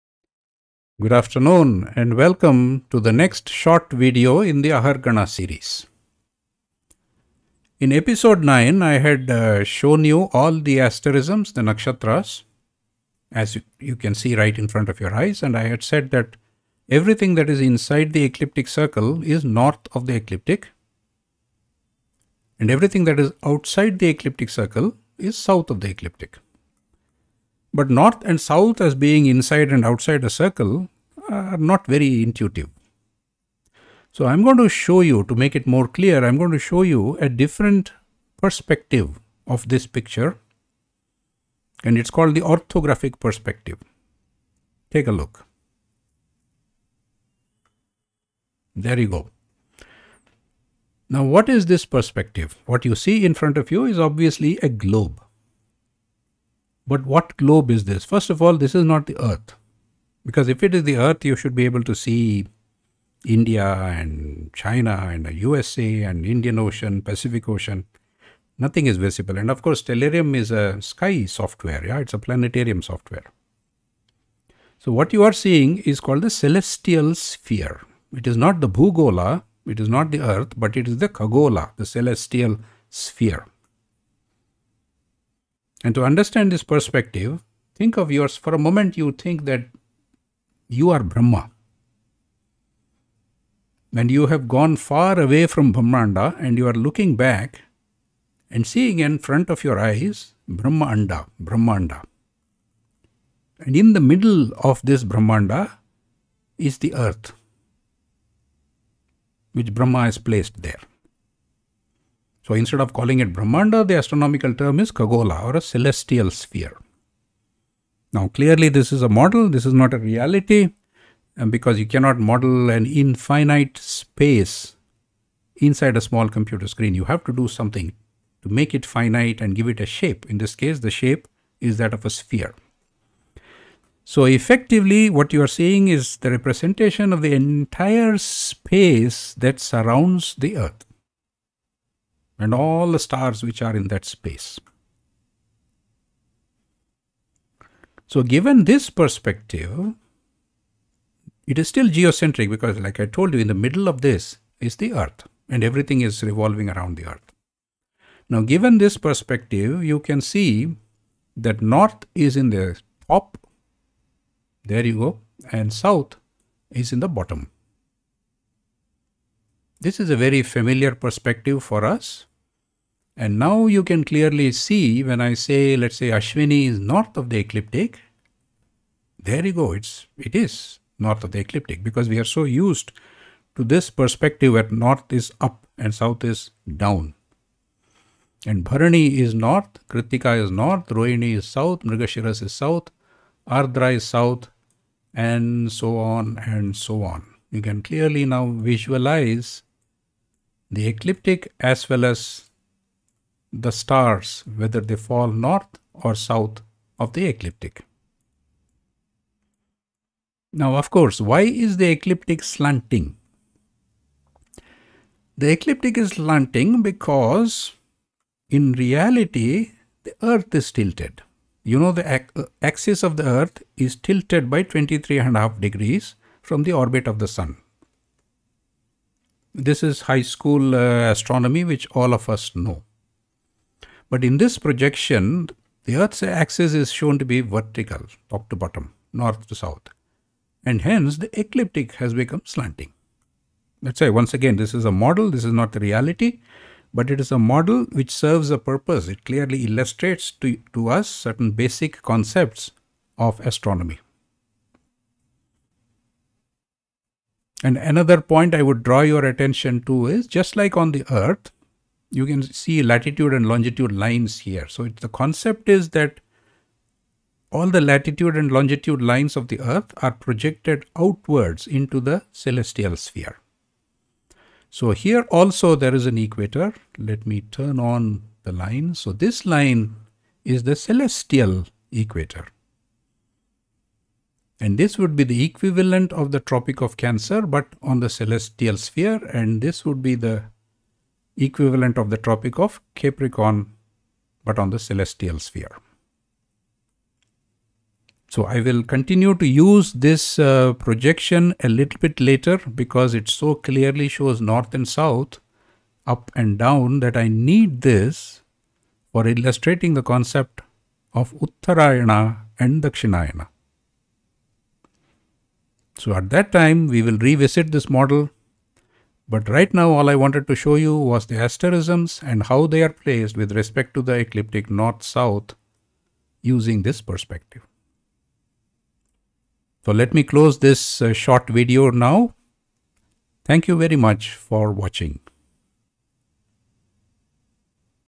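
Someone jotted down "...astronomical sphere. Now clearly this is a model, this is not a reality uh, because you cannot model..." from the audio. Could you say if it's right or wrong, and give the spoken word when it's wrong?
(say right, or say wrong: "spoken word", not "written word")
wrong: "celestial", not "astronomical".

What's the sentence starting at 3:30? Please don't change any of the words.
Now, of course, why is the ecliptic slanting?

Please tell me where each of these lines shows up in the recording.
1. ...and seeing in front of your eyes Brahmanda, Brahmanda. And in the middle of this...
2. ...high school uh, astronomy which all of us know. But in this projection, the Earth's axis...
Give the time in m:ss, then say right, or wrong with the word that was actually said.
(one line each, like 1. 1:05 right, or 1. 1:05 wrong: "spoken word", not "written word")
1. 1:38 right
2. 3:50 right.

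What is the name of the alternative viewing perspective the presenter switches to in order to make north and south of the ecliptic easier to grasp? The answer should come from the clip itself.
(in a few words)
orthographic perspective.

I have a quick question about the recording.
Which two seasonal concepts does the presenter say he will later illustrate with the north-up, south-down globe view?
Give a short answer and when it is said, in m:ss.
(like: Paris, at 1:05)
Uttarayana and Dakshinayana, at 5:11.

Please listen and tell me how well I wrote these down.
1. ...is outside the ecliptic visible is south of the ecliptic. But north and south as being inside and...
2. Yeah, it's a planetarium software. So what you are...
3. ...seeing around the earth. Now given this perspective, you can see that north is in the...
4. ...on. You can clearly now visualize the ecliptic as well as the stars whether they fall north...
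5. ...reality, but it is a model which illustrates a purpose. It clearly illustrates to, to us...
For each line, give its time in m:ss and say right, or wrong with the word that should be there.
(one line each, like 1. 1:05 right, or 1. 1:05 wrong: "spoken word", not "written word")
1. 0:23 wrong: "circle", not "visible"
2. 1:11 right
3. 2:36 wrong: "revolving", not "seeing"
4. 3:17 right
5. 4:05 wrong: "serves", not "illustrates".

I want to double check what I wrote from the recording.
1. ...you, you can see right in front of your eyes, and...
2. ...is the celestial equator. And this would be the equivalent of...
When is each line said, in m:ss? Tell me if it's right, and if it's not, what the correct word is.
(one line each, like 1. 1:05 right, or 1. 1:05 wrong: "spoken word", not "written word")
1. 0:13 right
2. 4:40 right.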